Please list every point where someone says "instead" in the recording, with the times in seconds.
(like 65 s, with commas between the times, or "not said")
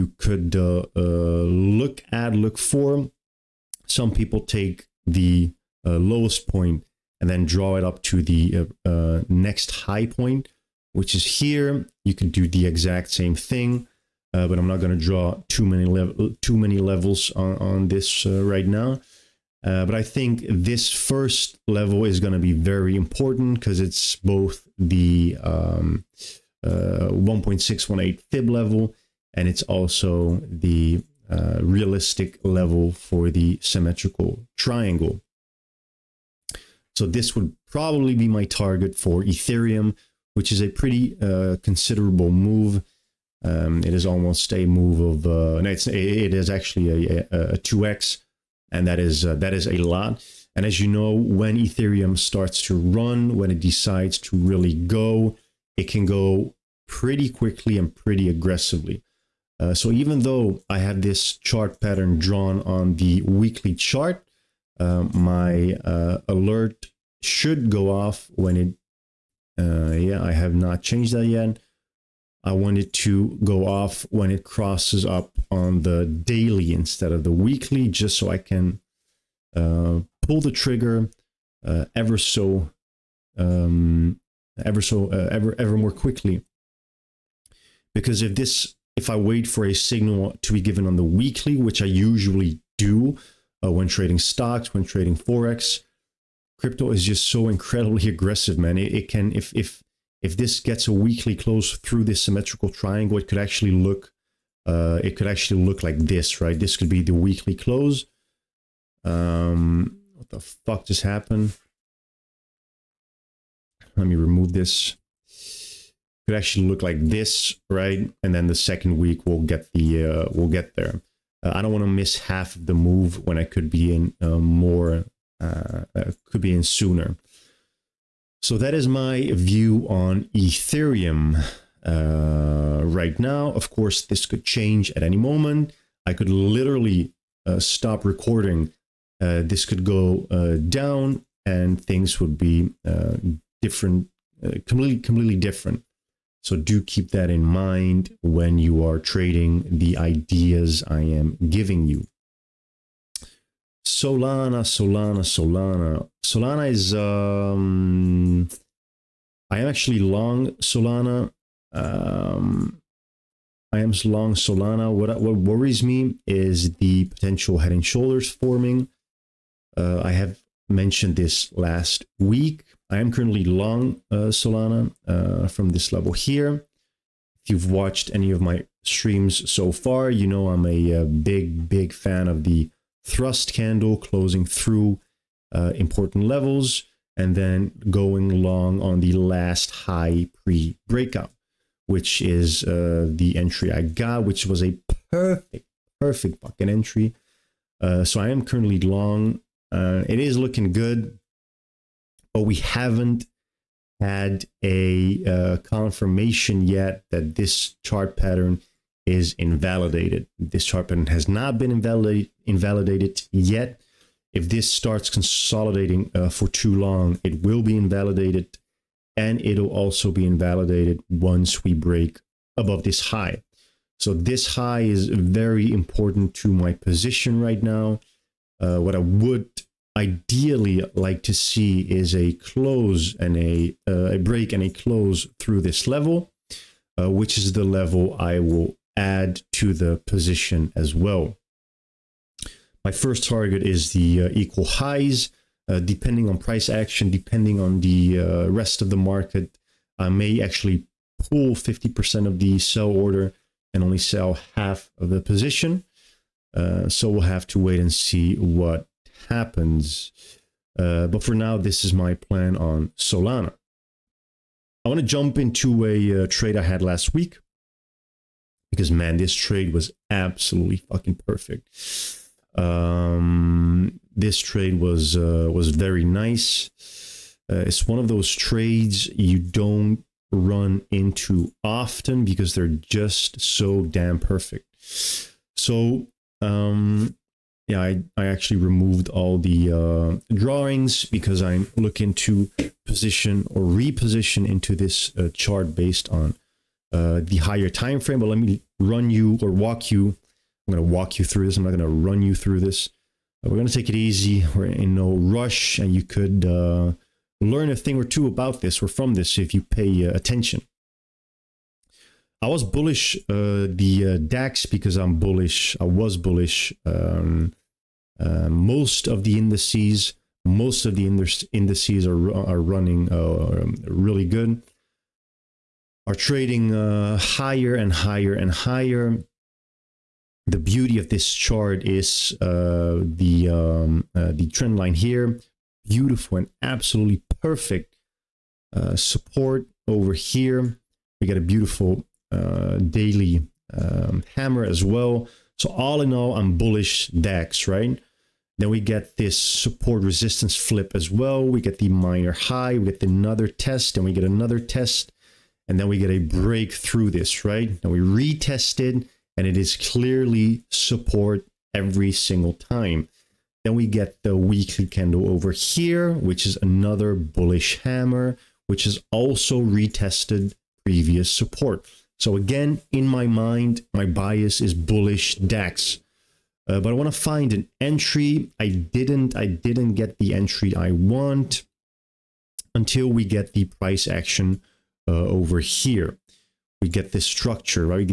76 s.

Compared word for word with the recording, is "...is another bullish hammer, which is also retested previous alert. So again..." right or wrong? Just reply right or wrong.
wrong.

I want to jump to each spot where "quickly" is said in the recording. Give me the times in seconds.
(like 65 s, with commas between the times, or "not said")
57 s, 85 s.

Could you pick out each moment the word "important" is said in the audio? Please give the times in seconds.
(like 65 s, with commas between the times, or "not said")
22 s, 185 s, 225 s.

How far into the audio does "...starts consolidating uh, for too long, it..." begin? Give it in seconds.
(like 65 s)
214 s.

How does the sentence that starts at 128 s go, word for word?
So that is my view on Ethereum uh, right now.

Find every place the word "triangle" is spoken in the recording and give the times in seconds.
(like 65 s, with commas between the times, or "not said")
34 s, 102 s.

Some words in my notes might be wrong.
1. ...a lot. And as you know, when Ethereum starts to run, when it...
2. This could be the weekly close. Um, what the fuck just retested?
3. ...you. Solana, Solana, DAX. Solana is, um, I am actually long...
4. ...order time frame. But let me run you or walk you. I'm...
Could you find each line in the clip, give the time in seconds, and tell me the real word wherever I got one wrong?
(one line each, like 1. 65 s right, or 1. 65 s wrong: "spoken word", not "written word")
1. 49 s right
2. 106 s wrong: "happened", not "retested"
3. 151 s wrong: "Solana", not "DAX"
4. 297 s wrong: "higher", not "order".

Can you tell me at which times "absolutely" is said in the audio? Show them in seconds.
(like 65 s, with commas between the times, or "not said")
270 s, 336 s.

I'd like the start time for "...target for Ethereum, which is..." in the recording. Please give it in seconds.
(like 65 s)
38 s.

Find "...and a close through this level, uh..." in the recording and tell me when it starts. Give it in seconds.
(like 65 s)
234 s.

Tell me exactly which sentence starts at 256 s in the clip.
Uh, so we'll have to wait and see what happens.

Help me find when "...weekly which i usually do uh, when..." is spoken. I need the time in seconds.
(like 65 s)
91 s.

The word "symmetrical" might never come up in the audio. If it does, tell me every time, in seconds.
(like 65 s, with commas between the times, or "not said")
33 s, 102 s.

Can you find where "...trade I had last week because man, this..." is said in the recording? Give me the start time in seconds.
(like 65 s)
266 s.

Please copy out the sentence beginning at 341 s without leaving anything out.
We got a beautiful uh, daily um, hammer as well.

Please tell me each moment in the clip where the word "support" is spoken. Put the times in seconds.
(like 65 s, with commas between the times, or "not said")
338 s, 349 s, 360 s, 371 s.